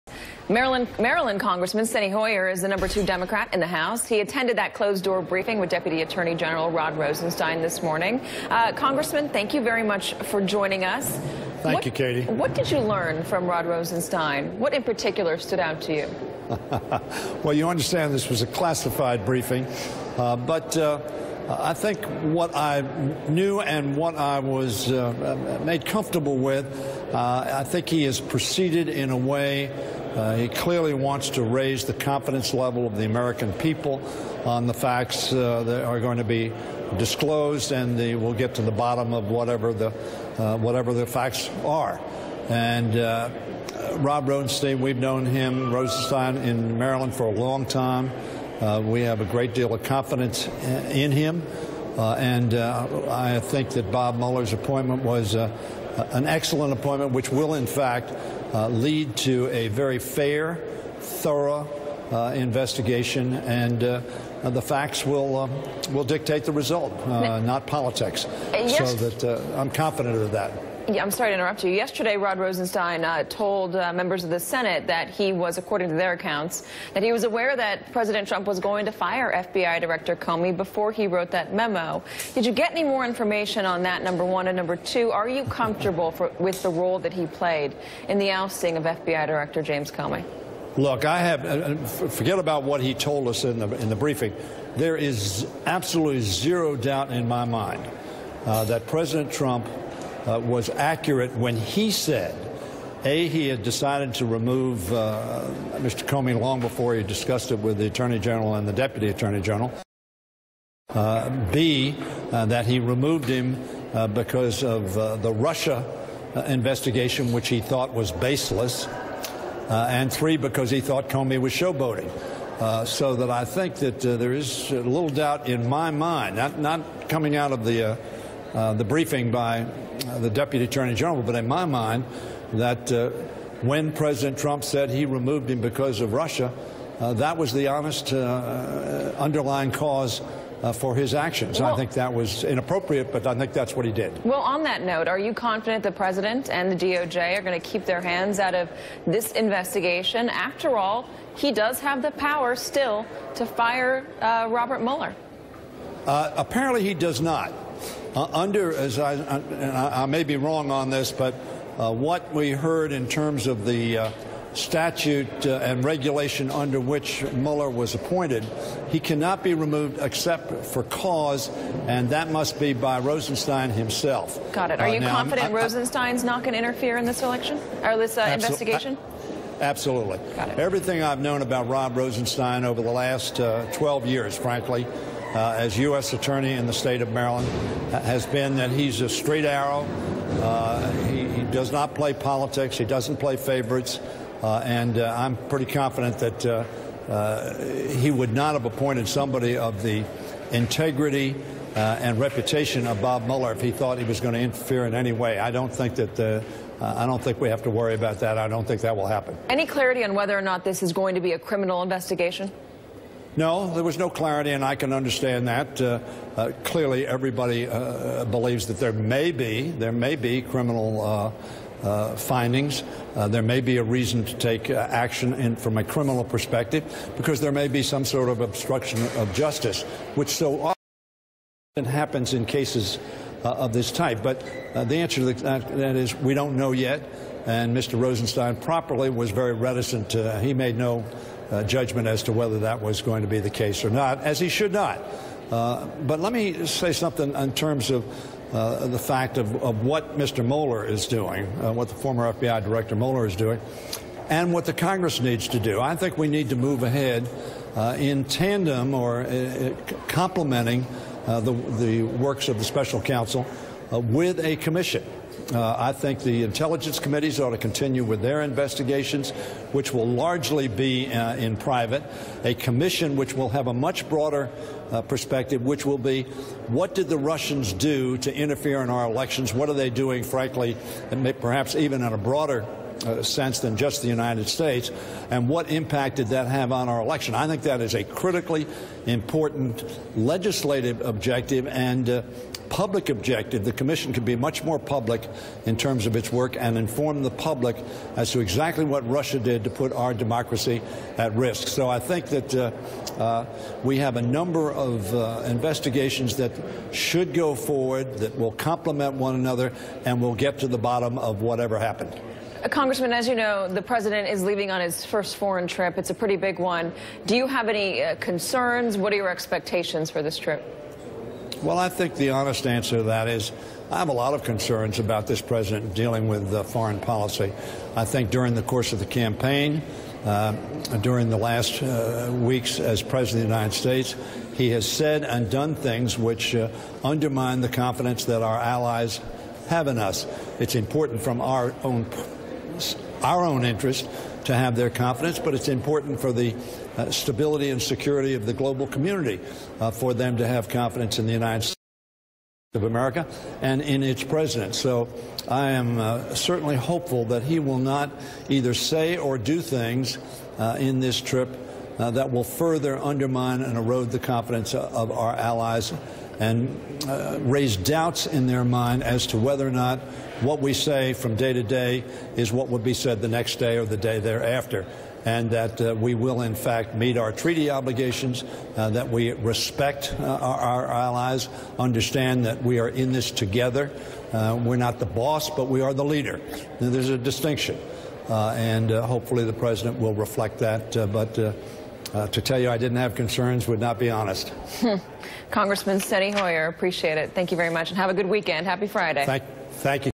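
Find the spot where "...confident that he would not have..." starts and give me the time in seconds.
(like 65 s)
195 s.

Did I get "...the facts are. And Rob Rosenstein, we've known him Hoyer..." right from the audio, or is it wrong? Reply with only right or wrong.
wrong.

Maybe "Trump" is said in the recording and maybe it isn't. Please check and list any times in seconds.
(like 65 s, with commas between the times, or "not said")
78 s, 99 s, 134 s.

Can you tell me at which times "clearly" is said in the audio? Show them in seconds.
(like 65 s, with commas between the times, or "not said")
30 s, 216 s.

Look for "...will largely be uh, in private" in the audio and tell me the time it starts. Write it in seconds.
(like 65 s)
269 s.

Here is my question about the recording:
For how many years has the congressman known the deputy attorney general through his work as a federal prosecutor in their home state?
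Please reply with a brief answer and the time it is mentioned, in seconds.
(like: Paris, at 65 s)
12 years, at 183 s.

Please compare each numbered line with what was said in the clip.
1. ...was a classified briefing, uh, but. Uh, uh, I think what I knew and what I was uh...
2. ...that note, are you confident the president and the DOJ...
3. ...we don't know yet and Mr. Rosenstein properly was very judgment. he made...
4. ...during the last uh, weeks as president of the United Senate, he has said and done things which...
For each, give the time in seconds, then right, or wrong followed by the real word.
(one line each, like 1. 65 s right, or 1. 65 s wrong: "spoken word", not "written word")
1. 18 s right
2. 144 s right
3. 236 s wrong: "reticent", not "judgment"
4. 331 s wrong: "States", not "Senate".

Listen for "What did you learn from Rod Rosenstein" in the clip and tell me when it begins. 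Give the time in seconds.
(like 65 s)
12 s.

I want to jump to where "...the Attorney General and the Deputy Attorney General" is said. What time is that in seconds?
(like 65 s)
107 s.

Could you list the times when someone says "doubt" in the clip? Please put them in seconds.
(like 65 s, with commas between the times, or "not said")
96 s, 125 s, 367 s.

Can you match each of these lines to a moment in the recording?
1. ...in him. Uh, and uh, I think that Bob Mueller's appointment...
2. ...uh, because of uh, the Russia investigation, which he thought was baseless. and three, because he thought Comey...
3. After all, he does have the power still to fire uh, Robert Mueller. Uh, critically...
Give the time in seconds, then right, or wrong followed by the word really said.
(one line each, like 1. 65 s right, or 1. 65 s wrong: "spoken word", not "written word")
1. 50 s right
2. 113 s right
3. 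150 s wrong: "apparently", not "critically".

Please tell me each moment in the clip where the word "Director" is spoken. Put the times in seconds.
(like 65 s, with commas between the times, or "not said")
79 s, 89 s, 252 s.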